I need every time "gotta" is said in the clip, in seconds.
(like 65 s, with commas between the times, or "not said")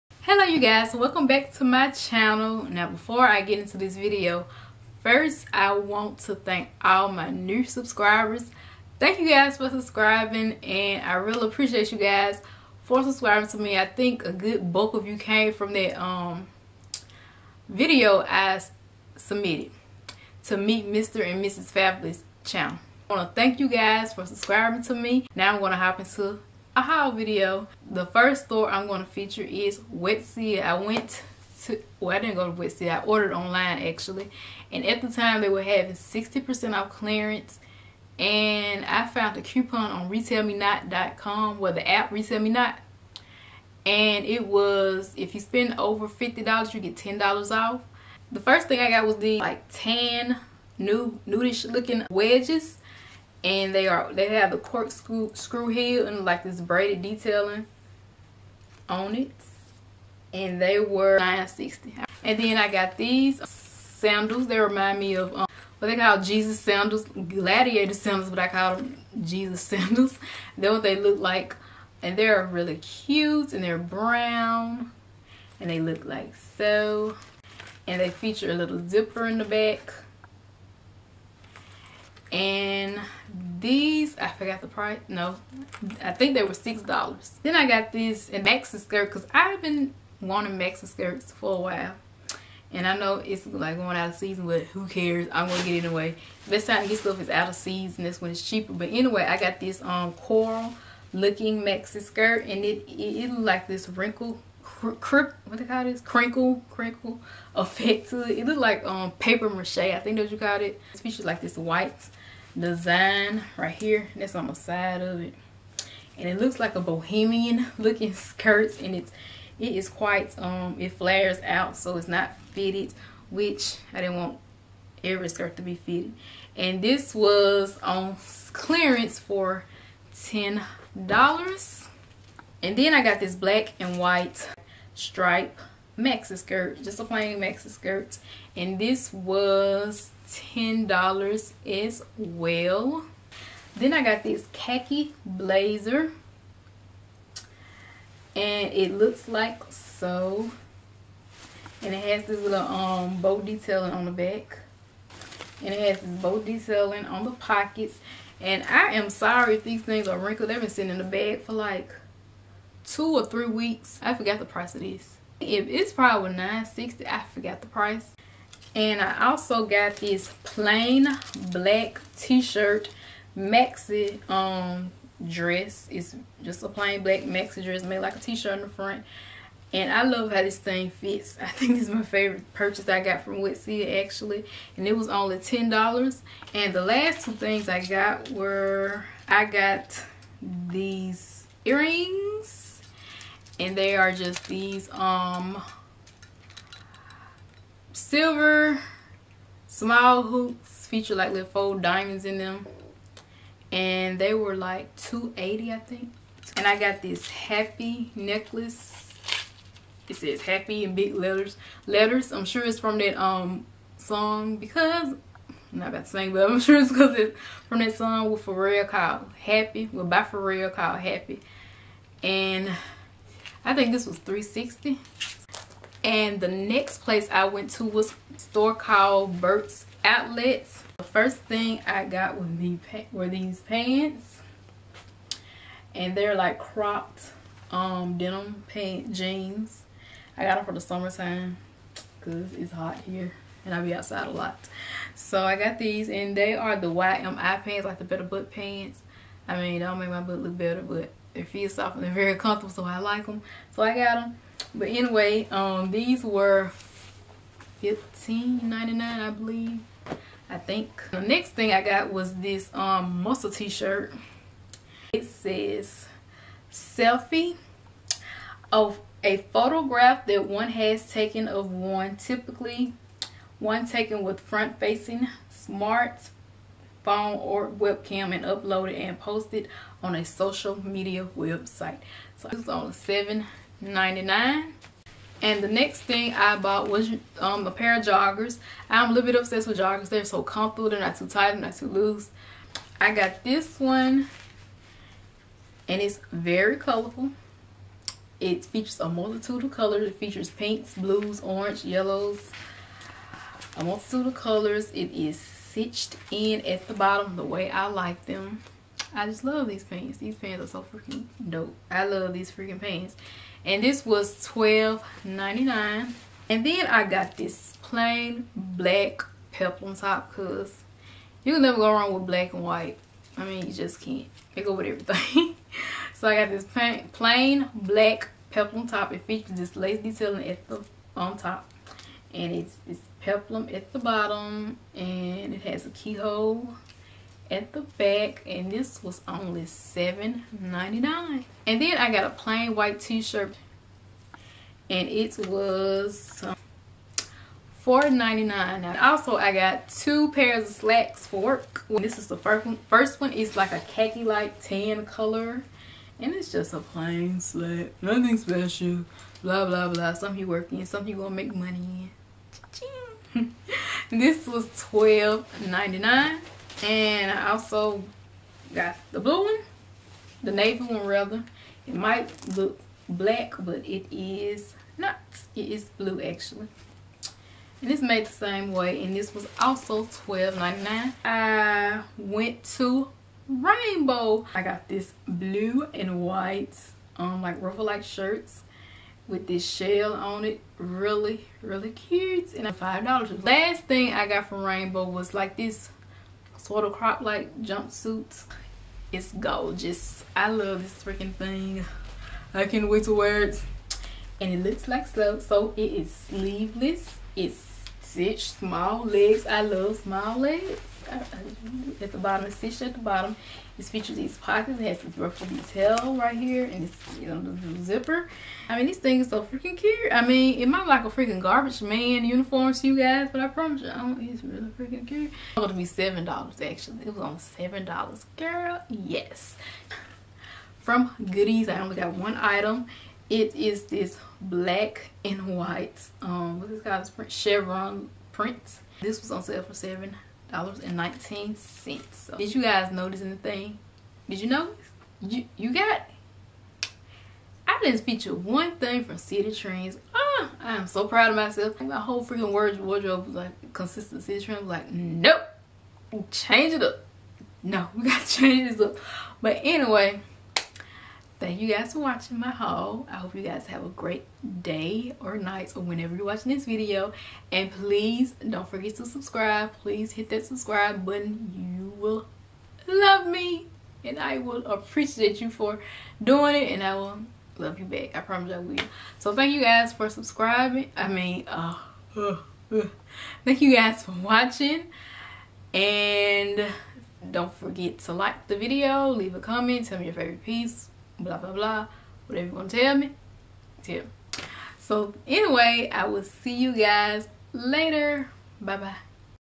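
458 s.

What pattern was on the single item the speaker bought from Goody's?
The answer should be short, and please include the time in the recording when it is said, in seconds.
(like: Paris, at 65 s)
Chevron print, at 437 s.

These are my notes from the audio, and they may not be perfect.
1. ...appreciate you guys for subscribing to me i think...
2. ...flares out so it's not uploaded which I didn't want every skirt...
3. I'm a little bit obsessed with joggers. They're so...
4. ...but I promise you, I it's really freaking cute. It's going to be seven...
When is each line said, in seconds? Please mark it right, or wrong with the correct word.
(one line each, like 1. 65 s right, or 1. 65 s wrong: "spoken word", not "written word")
1. 11 s right
2. 120 s wrong: "fitted", not "uploaded"
3. 288 s right
4. 423 s right.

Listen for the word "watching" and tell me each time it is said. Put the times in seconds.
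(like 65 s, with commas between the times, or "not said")
462 s, 466 s, 484 s.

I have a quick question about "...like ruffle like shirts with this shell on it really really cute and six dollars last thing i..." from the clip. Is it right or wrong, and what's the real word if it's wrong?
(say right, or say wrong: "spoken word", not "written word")
wrong: "five", not "six".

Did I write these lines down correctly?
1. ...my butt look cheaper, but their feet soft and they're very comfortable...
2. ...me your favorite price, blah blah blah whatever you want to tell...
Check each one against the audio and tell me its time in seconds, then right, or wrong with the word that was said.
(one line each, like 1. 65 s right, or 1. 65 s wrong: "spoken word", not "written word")
1. 250 s wrong: "better", not "cheaper"
2. 489 s wrong: "piece", not "price".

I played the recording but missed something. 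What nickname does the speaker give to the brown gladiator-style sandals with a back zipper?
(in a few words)
Jesus sandals.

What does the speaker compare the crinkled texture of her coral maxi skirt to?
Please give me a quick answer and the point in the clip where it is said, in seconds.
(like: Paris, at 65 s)
Paper mache, at 109 s.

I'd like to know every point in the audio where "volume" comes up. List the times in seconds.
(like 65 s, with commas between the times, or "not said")
not said.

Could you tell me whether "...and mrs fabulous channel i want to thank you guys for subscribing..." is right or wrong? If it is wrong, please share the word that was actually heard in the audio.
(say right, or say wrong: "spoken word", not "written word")
right.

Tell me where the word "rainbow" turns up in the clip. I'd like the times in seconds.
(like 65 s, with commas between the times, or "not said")
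383 s, 394 s.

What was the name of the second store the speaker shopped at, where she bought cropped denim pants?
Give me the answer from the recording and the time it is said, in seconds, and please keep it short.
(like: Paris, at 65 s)
Burke's Outlets, at 229 s.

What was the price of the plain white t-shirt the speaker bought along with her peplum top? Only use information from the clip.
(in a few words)
$4.99.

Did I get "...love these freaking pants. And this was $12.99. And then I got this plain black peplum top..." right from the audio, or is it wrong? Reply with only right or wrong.
right.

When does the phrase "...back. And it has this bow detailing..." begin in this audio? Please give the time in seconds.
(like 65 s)
154 s.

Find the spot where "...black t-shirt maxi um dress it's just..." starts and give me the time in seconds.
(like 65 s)
171 s.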